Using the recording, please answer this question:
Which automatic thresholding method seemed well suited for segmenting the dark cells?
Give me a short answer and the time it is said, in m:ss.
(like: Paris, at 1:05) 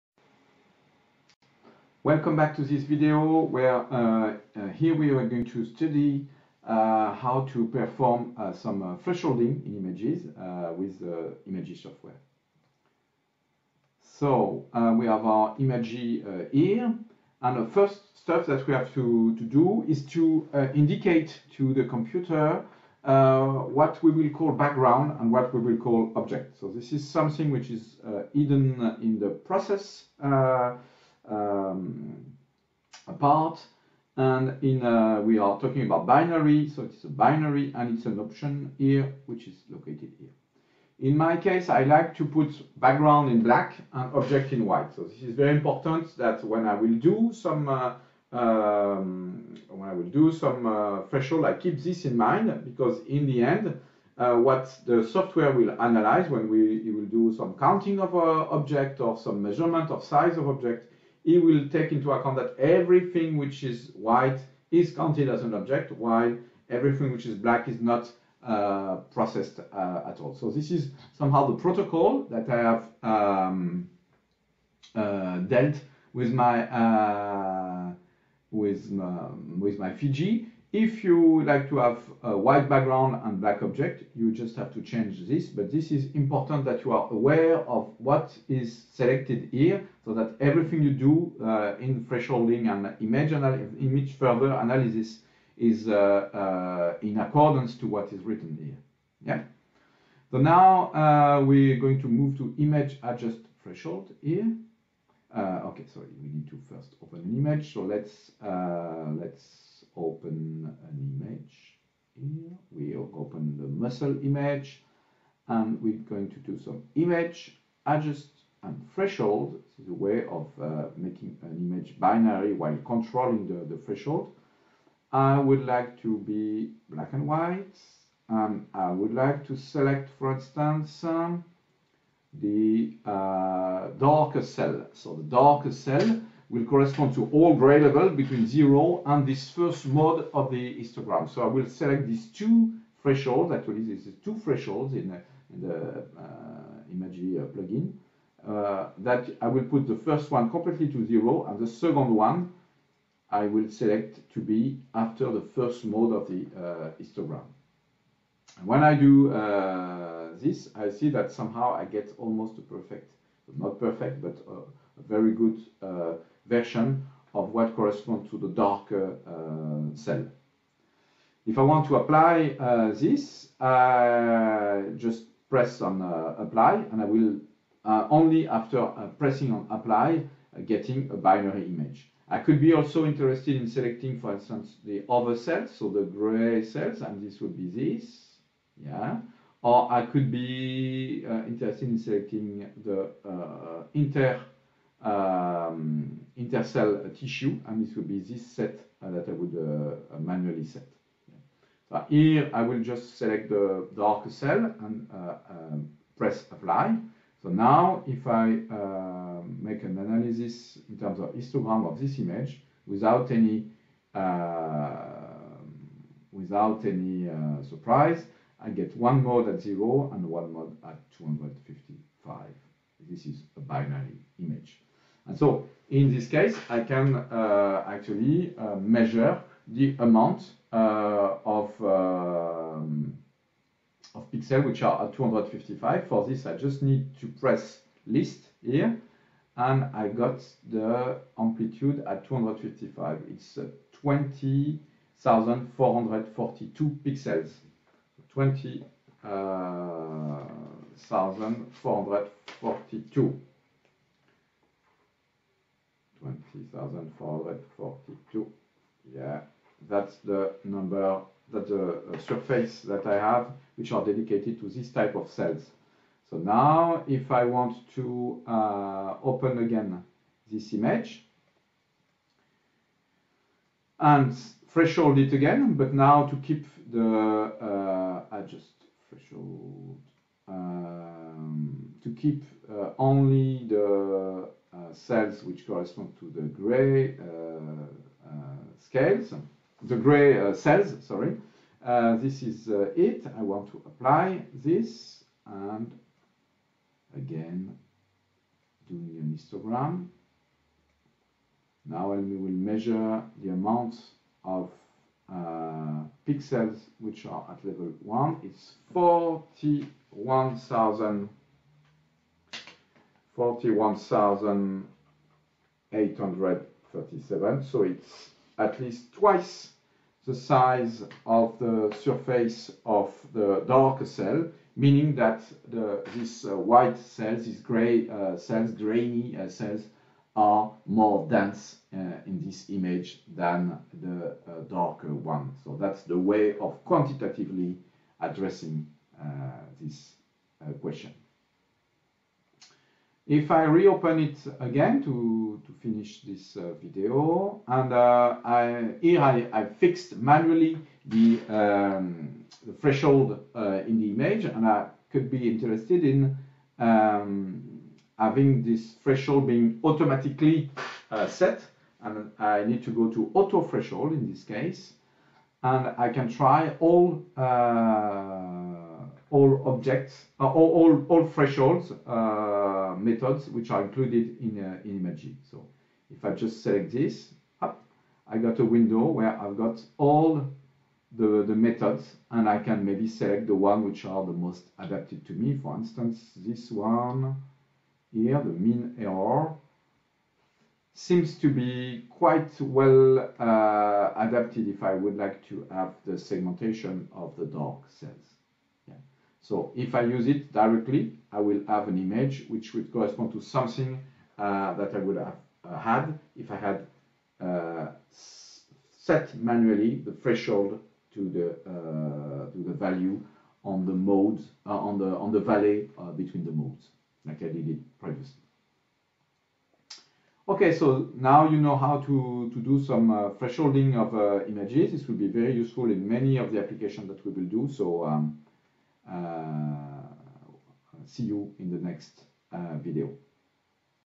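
MinError, at 6:28.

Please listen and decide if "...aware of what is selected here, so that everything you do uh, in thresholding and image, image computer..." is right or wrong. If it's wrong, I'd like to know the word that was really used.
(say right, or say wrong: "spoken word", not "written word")
wrong: "further", not "computer".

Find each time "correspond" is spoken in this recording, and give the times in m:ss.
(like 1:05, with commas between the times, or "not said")
2:16, 2:47, 4:45, 6:42.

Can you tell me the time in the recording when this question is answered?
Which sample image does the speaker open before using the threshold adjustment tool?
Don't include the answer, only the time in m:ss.
1:53.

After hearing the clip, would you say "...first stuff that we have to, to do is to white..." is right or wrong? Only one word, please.
wrong.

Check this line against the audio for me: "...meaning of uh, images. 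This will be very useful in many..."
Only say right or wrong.
wrong.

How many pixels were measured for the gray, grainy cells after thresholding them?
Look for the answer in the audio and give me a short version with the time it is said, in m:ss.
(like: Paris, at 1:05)
41,837, at 5:13.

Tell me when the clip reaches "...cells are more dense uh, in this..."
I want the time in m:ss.
5:29.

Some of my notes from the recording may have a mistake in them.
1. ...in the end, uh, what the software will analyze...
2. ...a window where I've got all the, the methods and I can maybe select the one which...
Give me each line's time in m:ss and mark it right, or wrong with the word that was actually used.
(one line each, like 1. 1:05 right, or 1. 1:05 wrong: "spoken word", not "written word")
1. 0:53 right
2. 6:18 right.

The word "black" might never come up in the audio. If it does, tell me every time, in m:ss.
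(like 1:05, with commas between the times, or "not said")
0:43, 1:07, 1:23, 2:06.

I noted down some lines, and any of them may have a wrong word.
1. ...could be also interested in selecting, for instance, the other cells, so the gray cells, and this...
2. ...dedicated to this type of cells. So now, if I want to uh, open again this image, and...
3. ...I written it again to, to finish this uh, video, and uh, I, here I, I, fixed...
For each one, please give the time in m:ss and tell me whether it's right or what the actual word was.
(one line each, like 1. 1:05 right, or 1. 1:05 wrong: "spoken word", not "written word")
1. 3:02 right
2. 4:24 right
3. 5:43 wrong: "reopen", not "written".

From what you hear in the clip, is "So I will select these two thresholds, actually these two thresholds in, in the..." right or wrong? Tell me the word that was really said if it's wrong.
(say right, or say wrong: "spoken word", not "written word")
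right.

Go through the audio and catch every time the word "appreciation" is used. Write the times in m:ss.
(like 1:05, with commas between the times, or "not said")
not said.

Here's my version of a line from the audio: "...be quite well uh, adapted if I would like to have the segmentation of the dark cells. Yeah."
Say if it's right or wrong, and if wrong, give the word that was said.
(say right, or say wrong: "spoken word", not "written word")
right.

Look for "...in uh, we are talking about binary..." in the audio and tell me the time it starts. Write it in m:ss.
0:34.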